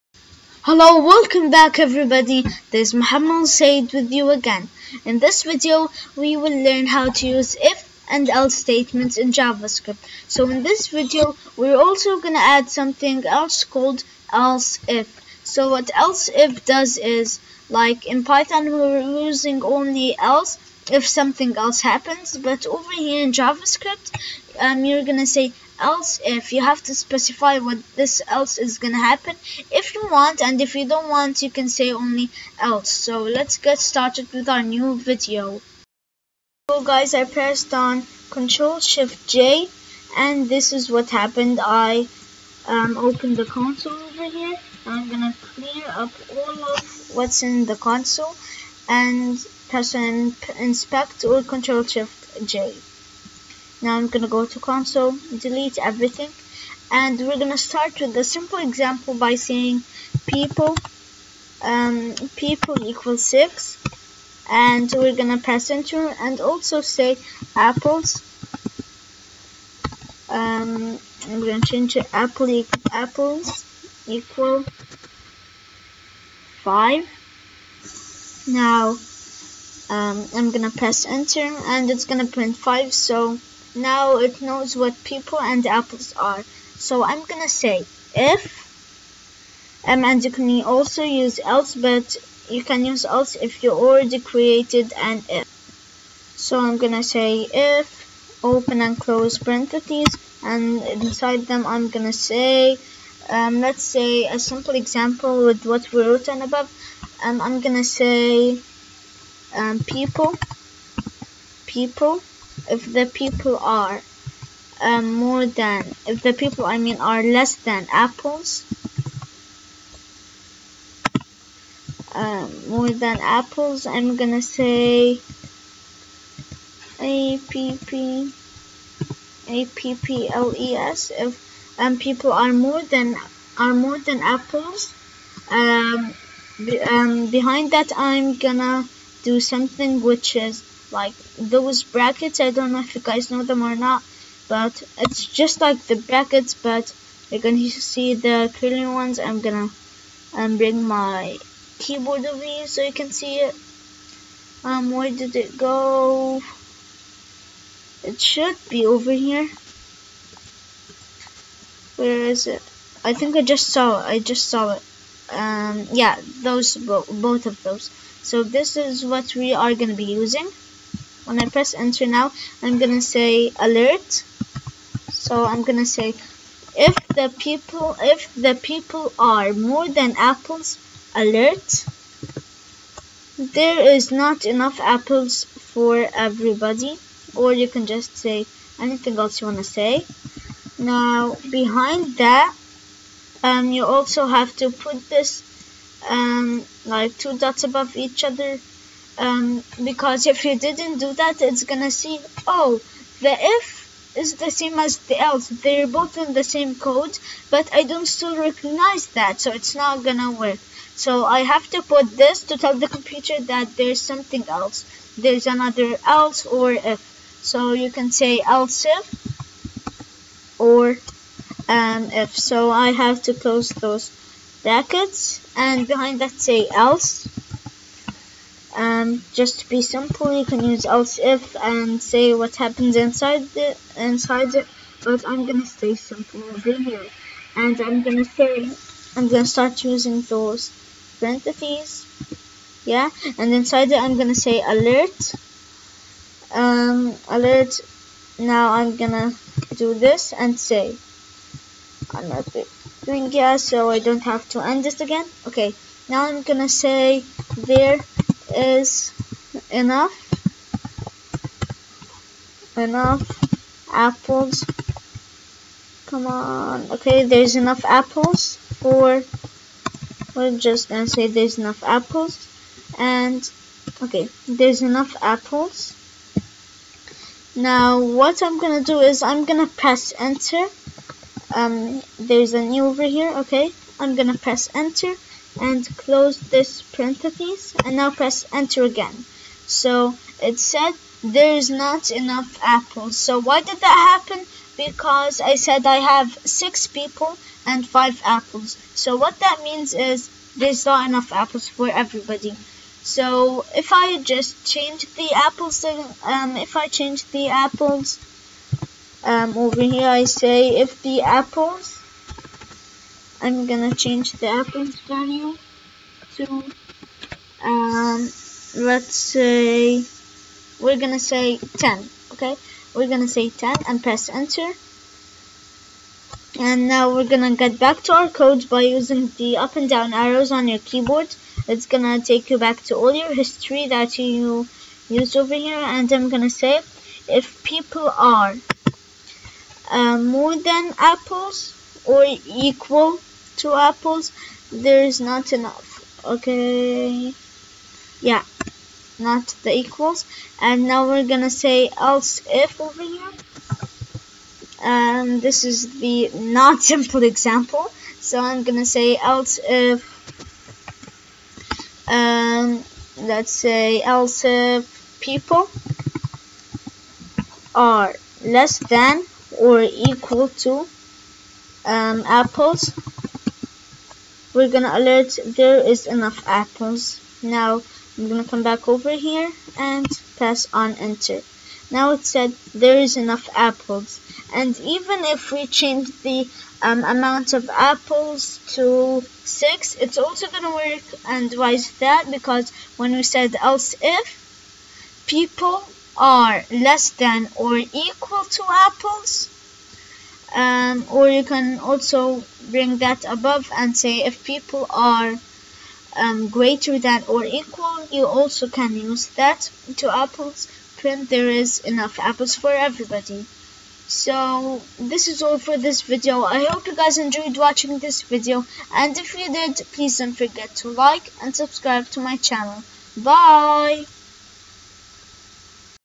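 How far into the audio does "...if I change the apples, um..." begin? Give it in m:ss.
5:06.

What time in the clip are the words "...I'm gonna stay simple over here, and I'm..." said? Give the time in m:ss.
3:55.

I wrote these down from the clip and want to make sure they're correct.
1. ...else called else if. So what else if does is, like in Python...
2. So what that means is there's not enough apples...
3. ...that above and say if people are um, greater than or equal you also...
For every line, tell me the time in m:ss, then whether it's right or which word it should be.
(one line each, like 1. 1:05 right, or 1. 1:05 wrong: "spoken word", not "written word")
1. 0:13 right
2. 4:58 right
3. 6:42 right.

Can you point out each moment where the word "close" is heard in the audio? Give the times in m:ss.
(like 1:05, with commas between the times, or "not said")
1:38, 3:43, 4:45.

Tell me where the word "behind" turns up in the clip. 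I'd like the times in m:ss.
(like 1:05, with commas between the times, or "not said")
2:17, 3:11, 3:45.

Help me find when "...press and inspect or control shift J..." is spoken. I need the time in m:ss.
0:49.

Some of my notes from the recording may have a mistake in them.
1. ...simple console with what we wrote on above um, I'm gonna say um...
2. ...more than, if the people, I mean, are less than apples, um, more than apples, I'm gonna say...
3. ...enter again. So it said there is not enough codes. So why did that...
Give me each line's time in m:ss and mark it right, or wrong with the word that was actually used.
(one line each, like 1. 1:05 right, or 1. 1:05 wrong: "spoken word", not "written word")
1. 1:44 wrong: "example", not "console"
2. 1:55 right
3. 4:48 wrong: "apples", not "codes".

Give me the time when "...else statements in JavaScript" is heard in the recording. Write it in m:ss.
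0:08.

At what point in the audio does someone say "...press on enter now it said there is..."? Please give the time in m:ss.
6:20.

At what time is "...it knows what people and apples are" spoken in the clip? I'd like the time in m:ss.
1:24.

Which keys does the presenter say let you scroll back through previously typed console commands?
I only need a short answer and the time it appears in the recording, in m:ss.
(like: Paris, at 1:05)
up and down arrows, at 5:29.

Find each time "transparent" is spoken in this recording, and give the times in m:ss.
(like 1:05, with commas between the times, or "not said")
not said.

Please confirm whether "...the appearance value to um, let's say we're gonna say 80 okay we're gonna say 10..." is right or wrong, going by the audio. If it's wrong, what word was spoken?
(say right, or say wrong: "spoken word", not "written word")
wrong: "10", not "80".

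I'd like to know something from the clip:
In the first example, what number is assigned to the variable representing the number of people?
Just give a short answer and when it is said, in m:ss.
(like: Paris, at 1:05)
6, at 1:02.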